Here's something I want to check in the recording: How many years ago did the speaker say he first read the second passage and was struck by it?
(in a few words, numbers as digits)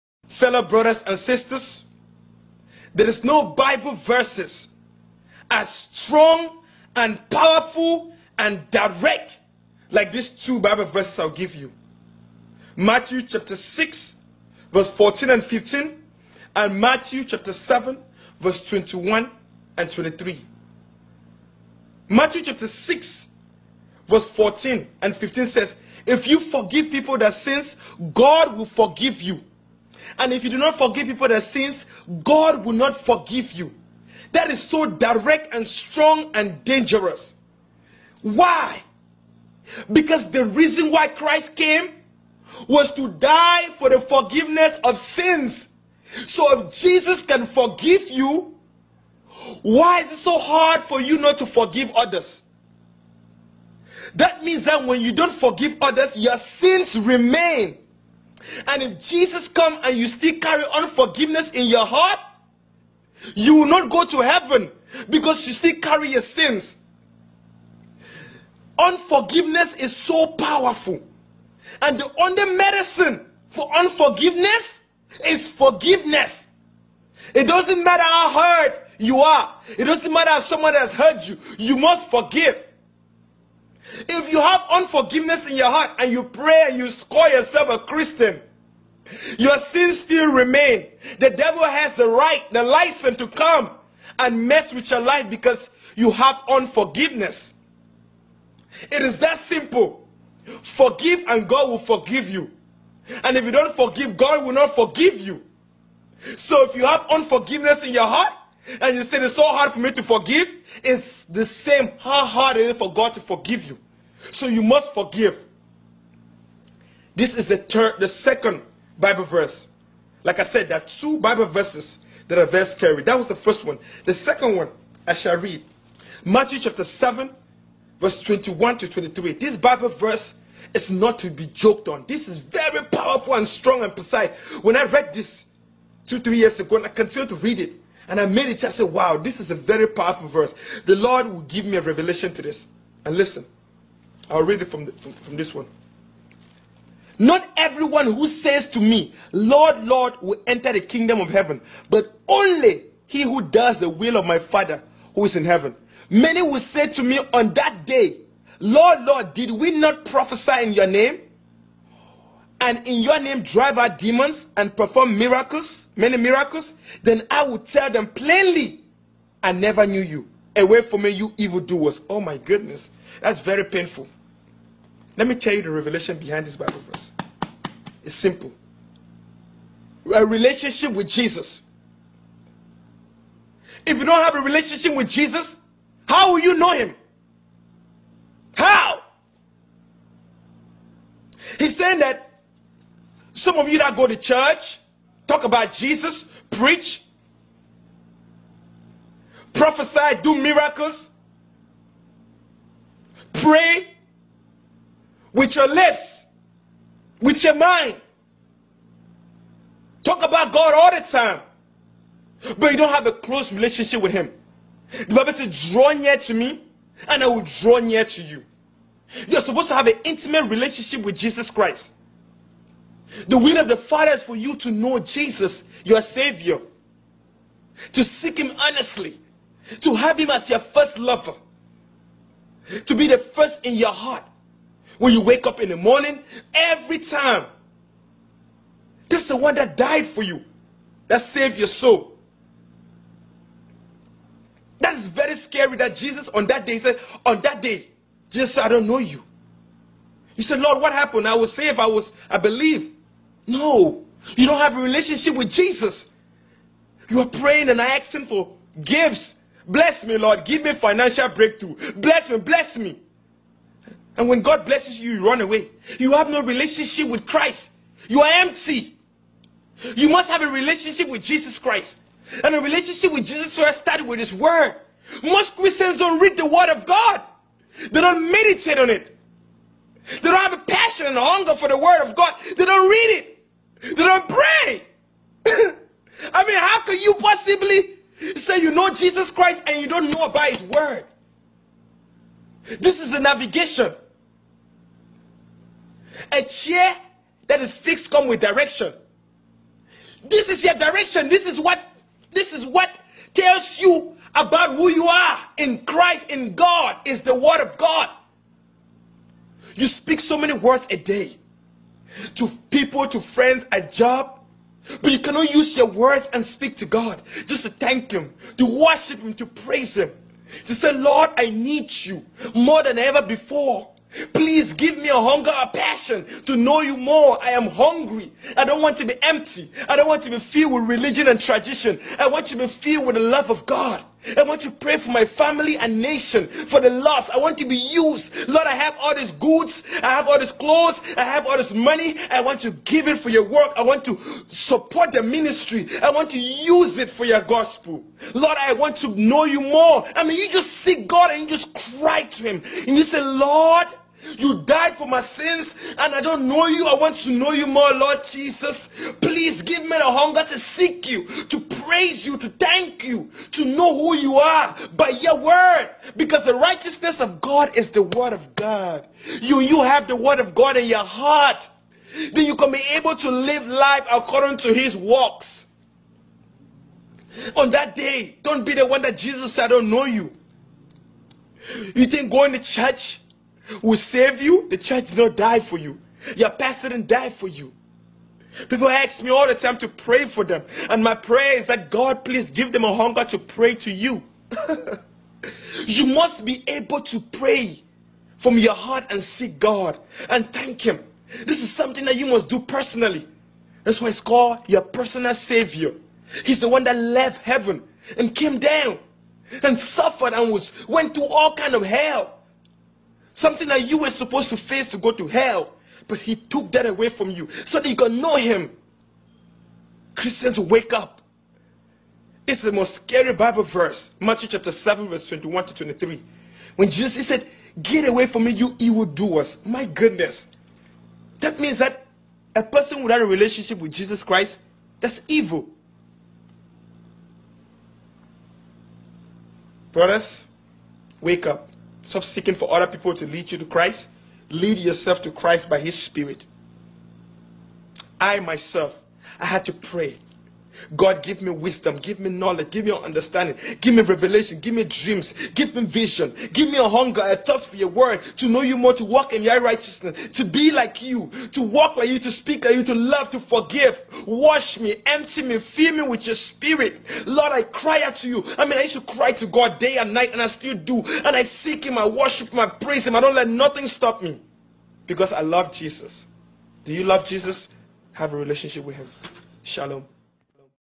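2 or 3 years.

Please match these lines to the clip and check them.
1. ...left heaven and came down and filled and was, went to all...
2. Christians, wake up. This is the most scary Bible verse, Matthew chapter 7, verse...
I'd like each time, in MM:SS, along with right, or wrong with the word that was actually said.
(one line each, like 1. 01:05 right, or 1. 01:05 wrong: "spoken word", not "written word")
1. 06:46 wrong: "suffered", not "filled"
2. 07:00 right.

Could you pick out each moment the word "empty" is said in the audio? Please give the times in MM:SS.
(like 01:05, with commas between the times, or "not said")
04:28, 05:29, 07:45.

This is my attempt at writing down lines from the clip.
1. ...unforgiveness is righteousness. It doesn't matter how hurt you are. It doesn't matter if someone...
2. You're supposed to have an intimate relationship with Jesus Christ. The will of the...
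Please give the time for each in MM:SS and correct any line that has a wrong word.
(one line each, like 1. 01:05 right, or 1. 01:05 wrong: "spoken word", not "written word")
1. 01:13 wrong: "forgiveness", not "righteousness"
2. 03:39 right.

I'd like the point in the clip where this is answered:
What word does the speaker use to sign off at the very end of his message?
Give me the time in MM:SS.
07:59.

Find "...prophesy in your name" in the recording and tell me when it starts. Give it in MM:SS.
02:40.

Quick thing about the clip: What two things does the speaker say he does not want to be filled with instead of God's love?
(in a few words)
Religion and tradition.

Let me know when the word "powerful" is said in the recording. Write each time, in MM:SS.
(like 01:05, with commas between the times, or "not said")
00:07, 01:10, 02:12, 02:19.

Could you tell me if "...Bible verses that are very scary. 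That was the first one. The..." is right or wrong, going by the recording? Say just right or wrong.
right.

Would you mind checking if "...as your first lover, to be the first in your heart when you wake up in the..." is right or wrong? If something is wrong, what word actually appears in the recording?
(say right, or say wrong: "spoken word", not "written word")
right.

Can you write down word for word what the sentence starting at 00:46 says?
So if Jesus can forgive you, why is it so hard for you not to forgive others?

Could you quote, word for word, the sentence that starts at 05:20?
To say, Lord, I need you more than ever before.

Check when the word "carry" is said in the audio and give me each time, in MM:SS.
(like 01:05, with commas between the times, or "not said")
01:00, 01:05.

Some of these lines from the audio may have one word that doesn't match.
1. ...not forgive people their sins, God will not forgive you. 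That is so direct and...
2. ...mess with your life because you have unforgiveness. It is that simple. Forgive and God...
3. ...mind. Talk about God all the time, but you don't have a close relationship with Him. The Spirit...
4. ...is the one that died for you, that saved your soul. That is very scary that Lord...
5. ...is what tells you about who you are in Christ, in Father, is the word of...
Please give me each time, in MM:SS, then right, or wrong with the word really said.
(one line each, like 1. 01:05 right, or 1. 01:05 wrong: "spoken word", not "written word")
1. 00:30 right
2. 01:34 right
3. 03:27 wrong: "Bible", not "Spirit"
4. 03:59 wrong: "Jesus", not "Lord"
5. 05:02 wrong: "God", not "Father".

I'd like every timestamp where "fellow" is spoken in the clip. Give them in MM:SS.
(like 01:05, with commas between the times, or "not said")
00:00.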